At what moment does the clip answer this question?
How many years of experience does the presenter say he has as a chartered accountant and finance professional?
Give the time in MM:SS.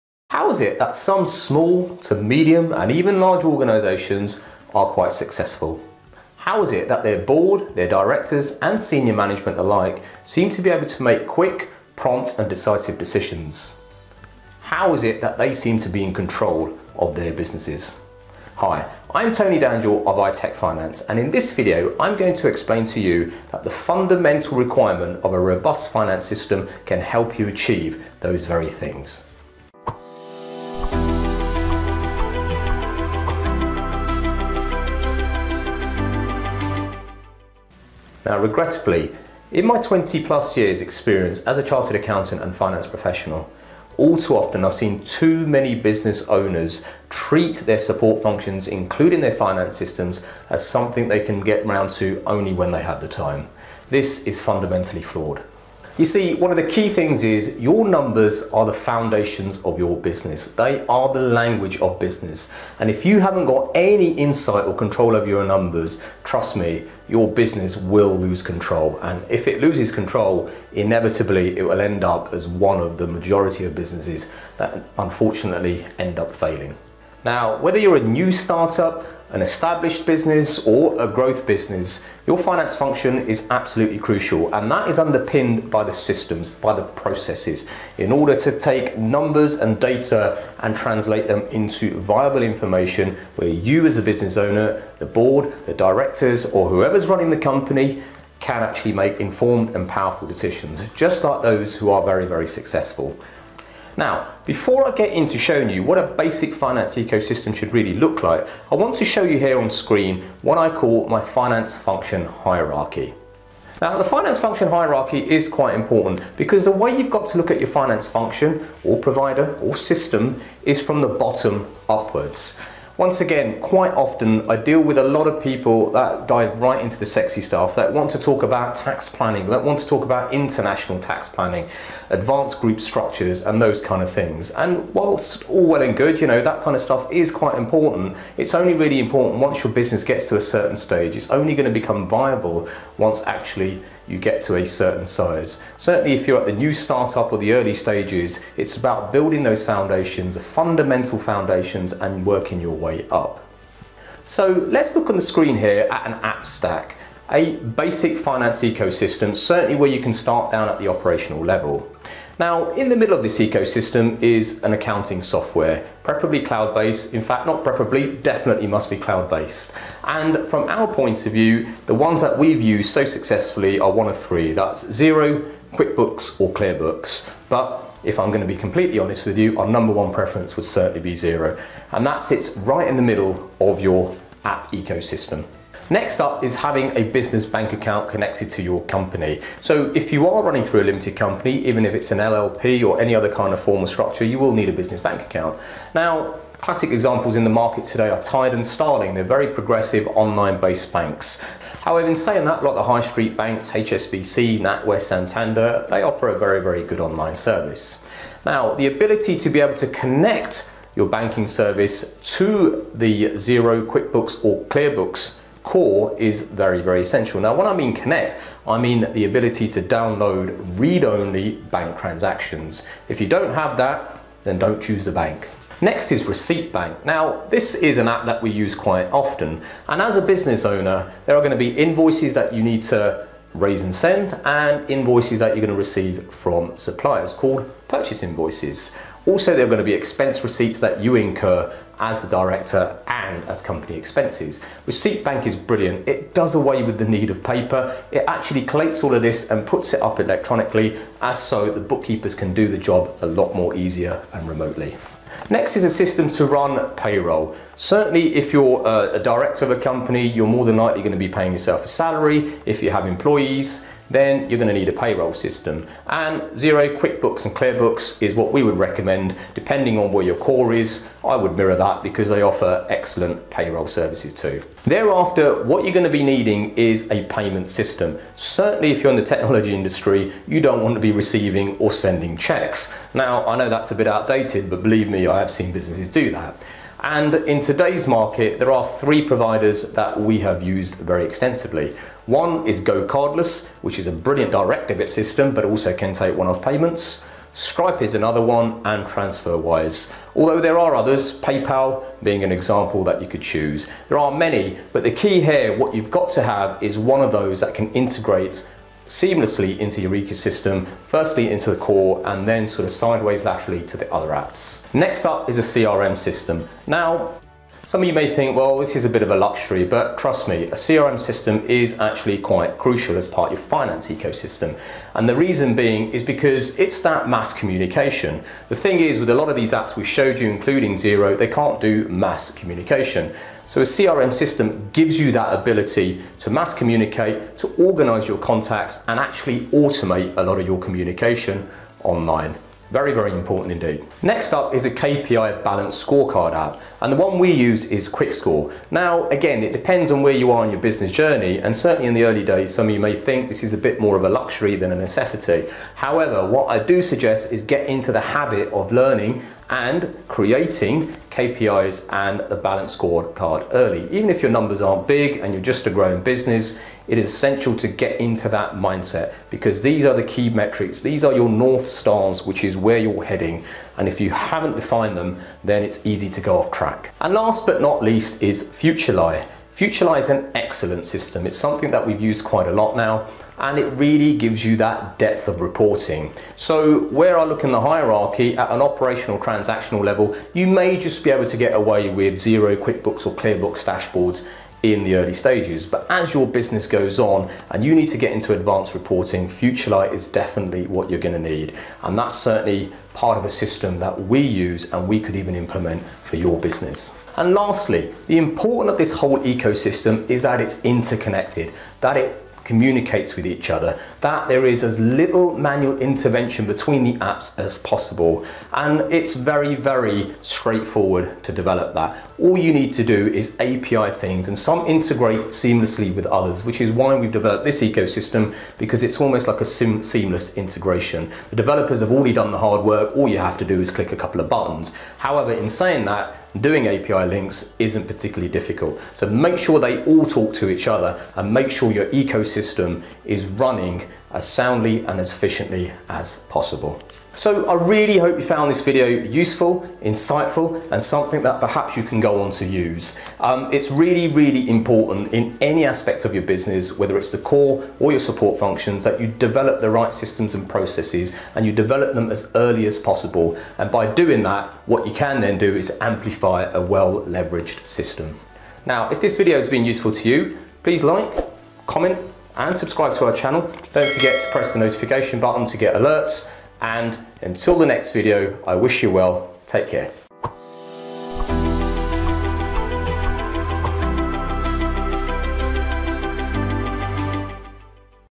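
00:39.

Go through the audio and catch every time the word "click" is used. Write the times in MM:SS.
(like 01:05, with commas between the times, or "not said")
07:13.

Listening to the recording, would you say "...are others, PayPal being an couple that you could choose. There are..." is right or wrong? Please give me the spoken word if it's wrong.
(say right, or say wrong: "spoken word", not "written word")
wrong: "example", not "couple".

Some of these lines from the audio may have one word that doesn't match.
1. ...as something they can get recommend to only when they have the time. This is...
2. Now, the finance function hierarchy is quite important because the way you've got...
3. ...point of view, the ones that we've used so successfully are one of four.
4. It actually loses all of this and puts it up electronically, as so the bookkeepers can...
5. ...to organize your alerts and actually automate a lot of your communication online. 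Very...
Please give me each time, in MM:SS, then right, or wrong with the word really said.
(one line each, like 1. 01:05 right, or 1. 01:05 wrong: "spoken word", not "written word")
1. 00:50 wrong: "round", not "recommend"
2. 01:53 right
3. 02:50 wrong: "three", not "four"
4. 04:08 wrong: "collates", not "loses"
5. 05:37 wrong: "contacts", not "alerts".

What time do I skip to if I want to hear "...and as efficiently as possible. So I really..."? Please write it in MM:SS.
07:25.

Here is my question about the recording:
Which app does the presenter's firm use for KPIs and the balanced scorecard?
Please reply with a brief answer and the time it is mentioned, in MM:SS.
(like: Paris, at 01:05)
QuickScore, at 05:48.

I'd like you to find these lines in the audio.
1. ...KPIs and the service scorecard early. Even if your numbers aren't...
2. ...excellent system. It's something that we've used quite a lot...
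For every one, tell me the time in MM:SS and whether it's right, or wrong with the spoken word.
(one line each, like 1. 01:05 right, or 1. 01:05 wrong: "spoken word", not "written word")
1. 06:01 wrong: "balance", not "service"
2. 06:20 right.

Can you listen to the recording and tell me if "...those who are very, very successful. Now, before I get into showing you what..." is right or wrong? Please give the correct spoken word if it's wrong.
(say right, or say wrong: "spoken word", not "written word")
right.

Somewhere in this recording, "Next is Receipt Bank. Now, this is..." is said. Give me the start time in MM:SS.
03:45.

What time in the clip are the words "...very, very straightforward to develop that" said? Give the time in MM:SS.
06:59.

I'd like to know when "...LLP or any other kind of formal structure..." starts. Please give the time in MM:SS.
03:12.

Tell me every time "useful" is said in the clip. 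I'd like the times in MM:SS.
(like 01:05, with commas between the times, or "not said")
07:29, 07:49.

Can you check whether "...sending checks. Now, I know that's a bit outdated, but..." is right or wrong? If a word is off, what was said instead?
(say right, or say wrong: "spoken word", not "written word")
right.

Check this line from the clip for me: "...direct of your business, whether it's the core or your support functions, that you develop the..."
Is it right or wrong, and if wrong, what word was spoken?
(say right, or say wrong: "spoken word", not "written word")
wrong: "aspect", not "direct".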